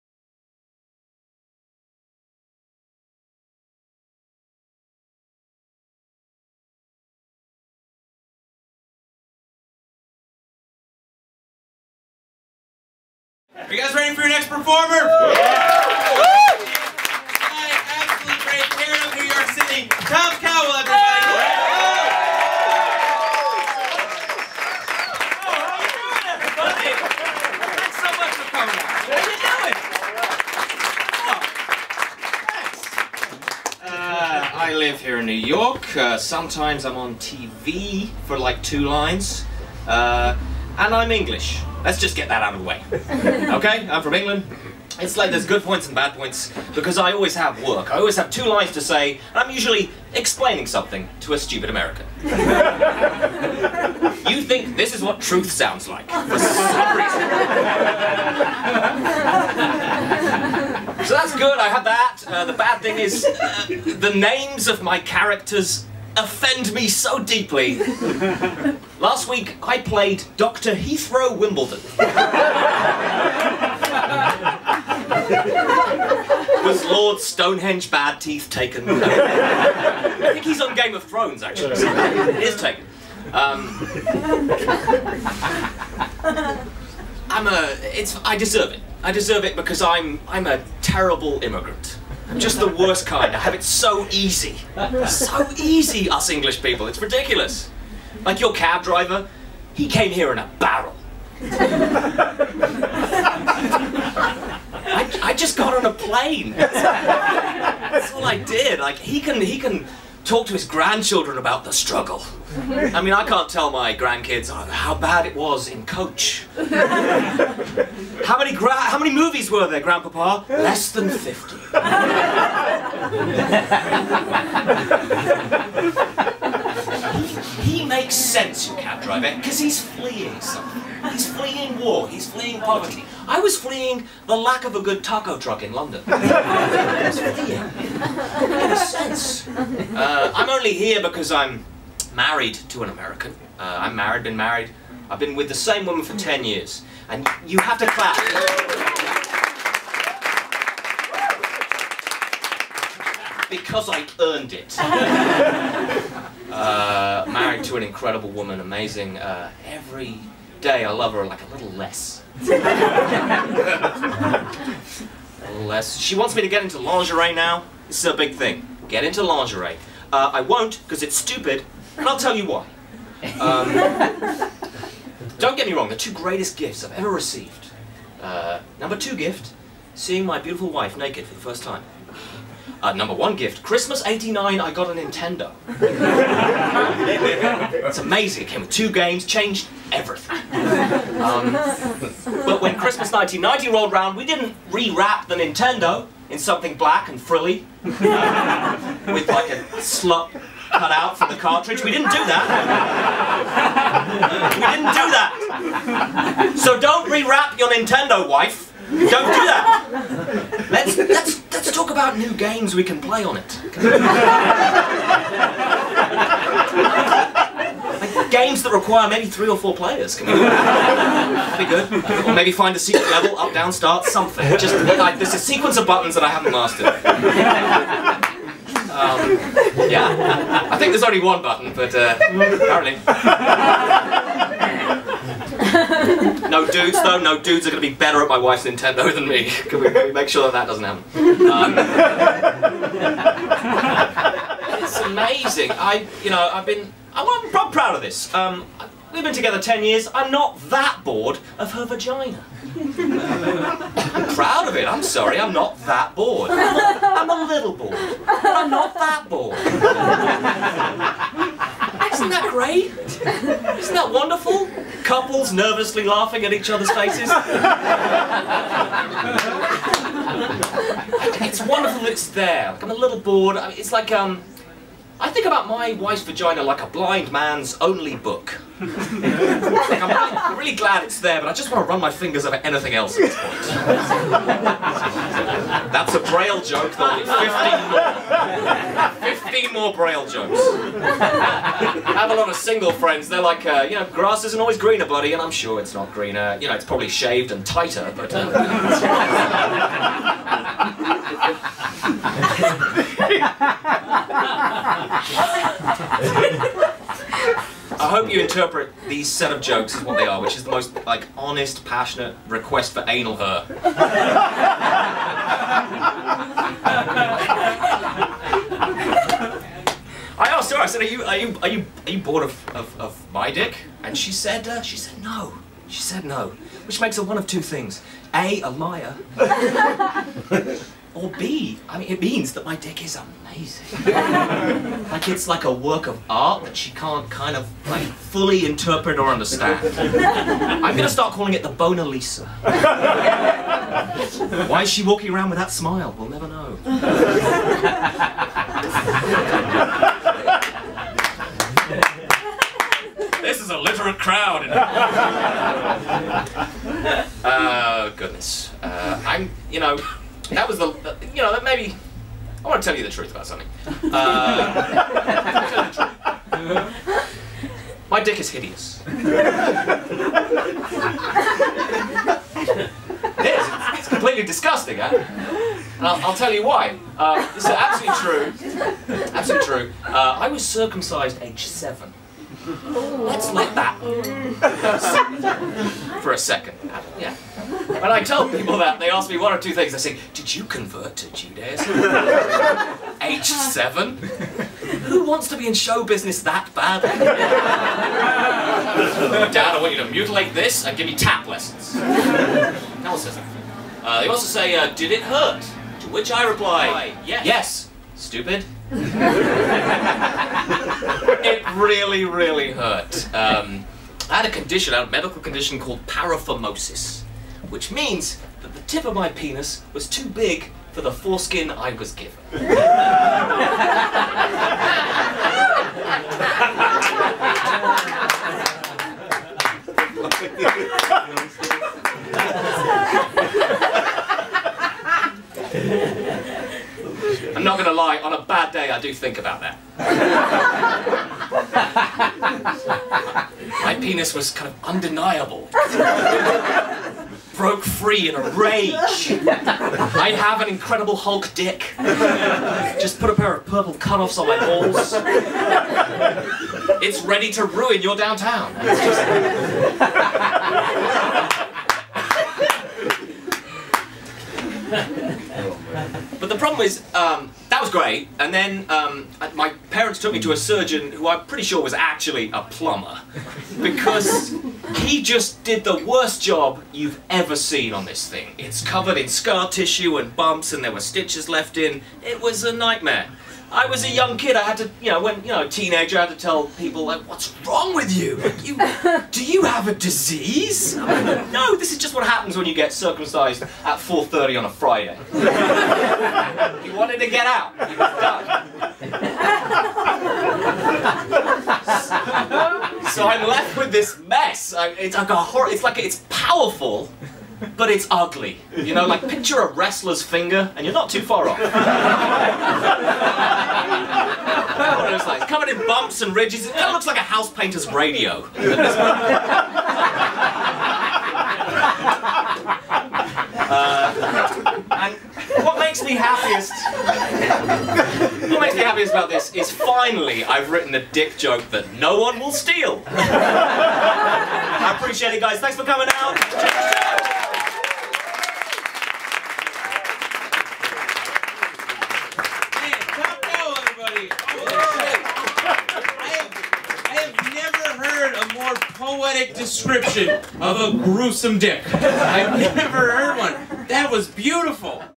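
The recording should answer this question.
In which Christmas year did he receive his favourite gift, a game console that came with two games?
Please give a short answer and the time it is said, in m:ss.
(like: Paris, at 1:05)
1989, at 3:03.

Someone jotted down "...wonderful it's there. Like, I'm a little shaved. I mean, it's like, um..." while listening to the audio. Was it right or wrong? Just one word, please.
wrong.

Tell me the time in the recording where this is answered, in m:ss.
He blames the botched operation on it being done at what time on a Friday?
8:13.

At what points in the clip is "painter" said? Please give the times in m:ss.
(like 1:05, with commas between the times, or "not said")
8:37.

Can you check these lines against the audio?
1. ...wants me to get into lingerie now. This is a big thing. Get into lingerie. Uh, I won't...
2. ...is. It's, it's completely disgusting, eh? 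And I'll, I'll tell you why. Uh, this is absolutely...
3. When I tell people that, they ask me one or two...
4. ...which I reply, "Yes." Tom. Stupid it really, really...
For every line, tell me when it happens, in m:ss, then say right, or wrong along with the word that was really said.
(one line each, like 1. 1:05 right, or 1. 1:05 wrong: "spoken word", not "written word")
1. 2:46 right
2. 6:09 right
3. 6:27 right
4. 6:46 wrong: "Yes", not "Tom".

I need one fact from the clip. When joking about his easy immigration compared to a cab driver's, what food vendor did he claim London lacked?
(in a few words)
taco truck.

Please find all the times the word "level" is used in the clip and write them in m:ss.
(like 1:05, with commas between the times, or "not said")
3:43.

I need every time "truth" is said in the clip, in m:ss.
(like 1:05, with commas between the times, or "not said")
0:55, 6:03.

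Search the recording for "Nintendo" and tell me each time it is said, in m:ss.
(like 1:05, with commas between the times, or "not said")
3:04, 3:15, 3:27, 3:58.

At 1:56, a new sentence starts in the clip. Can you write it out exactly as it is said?
how many how many movies were there, Grandpapa?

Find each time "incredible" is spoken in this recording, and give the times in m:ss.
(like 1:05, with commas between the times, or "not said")
2:37, 7:30.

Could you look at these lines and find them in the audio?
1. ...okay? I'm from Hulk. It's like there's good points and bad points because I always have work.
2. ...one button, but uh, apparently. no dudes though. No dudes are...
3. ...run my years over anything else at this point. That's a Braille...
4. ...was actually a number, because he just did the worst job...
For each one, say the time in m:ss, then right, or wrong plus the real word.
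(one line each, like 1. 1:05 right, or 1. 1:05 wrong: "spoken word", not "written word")
1. 0:43 wrong: "England", not "Hulk"
2. 3:51 right
3. 4:41 wrong: "fingers", not "years"
4. 7:51 wrong: "plumber", not "number".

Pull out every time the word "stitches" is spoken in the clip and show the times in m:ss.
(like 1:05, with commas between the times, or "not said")
8:01.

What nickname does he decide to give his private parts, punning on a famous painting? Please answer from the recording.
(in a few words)
Bona Lisa.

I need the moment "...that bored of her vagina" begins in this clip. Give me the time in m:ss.
4:10.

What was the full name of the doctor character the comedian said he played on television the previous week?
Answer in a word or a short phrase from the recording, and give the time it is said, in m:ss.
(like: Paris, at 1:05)
Dr. Heathrow Wimbledon, at 1:10.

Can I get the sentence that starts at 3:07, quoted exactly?
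it's amazing, it came with two games, changed everything.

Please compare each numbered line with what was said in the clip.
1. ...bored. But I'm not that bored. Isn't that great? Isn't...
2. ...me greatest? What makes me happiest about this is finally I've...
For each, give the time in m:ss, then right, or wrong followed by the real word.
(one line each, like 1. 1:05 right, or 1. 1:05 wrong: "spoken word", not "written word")
1. 4:17 right
2. 8:46 wrong: "happiest", not "greatest".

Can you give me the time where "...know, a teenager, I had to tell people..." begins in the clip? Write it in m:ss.
8:05.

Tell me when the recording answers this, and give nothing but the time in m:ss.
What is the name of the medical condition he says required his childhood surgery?
6:56.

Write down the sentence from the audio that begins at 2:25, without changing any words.
I've been with the same woman for 10 years.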